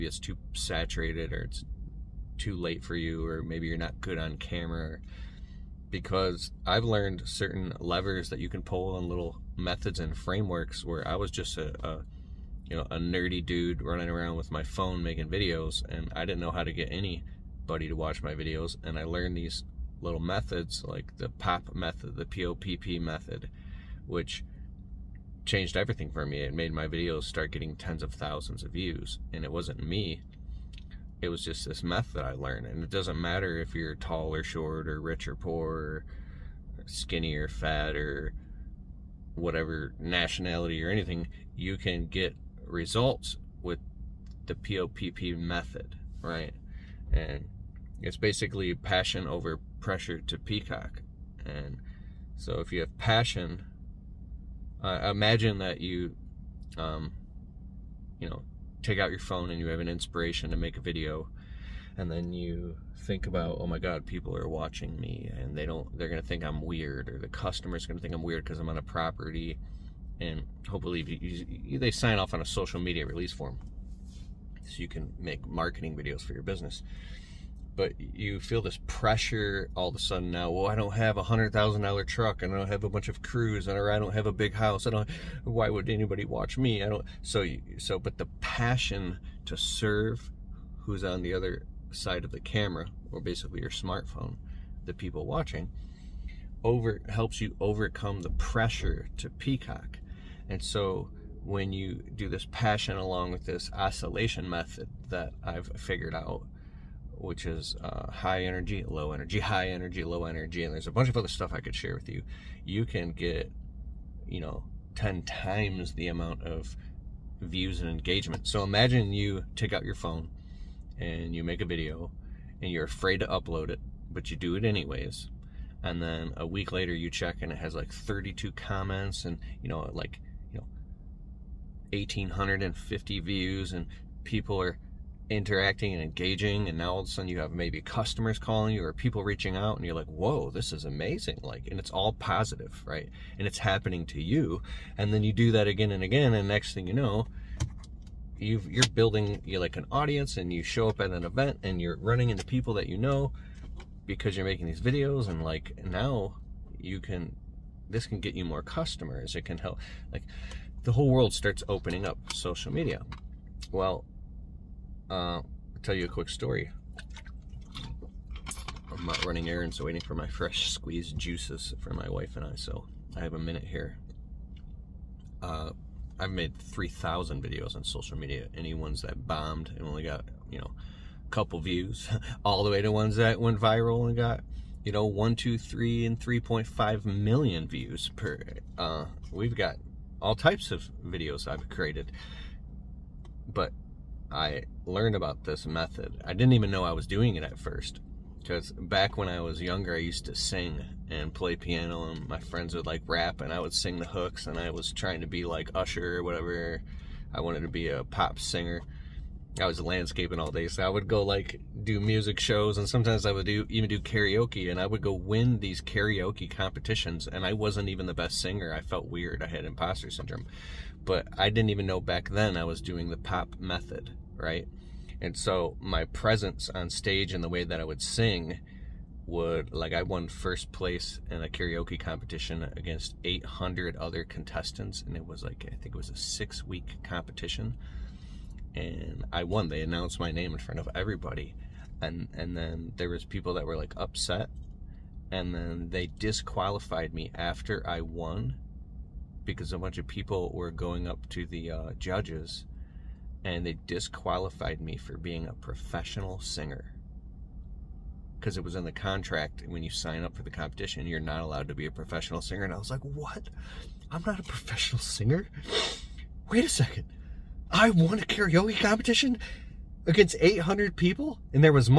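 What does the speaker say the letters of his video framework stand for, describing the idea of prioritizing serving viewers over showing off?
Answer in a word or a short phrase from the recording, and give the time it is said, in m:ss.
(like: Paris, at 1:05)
passion over pressure to peacock, at 0:48.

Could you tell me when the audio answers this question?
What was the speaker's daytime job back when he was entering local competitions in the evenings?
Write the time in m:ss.
3:29.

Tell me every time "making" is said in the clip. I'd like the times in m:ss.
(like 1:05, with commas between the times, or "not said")
0:15, 2:34.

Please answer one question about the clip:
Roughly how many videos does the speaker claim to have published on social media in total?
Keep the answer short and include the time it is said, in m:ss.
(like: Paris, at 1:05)
3,000, at 2:56.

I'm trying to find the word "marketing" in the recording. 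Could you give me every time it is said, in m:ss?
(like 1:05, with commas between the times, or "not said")
1:15.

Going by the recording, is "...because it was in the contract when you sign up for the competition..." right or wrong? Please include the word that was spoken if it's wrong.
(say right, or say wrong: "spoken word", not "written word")
right.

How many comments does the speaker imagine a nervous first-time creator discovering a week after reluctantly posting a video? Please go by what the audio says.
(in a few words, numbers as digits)
32.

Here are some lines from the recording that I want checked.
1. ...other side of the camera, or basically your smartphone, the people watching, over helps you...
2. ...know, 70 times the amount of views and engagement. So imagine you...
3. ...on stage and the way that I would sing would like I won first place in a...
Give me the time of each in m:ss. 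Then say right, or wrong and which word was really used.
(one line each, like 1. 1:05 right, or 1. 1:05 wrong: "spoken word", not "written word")
1. 1:31 right
2. 1:54 wrong: "10", not "70"
3. 3:46 right.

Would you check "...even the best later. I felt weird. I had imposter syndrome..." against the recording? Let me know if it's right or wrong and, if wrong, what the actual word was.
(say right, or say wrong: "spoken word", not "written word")
wrong: "singer", not "later".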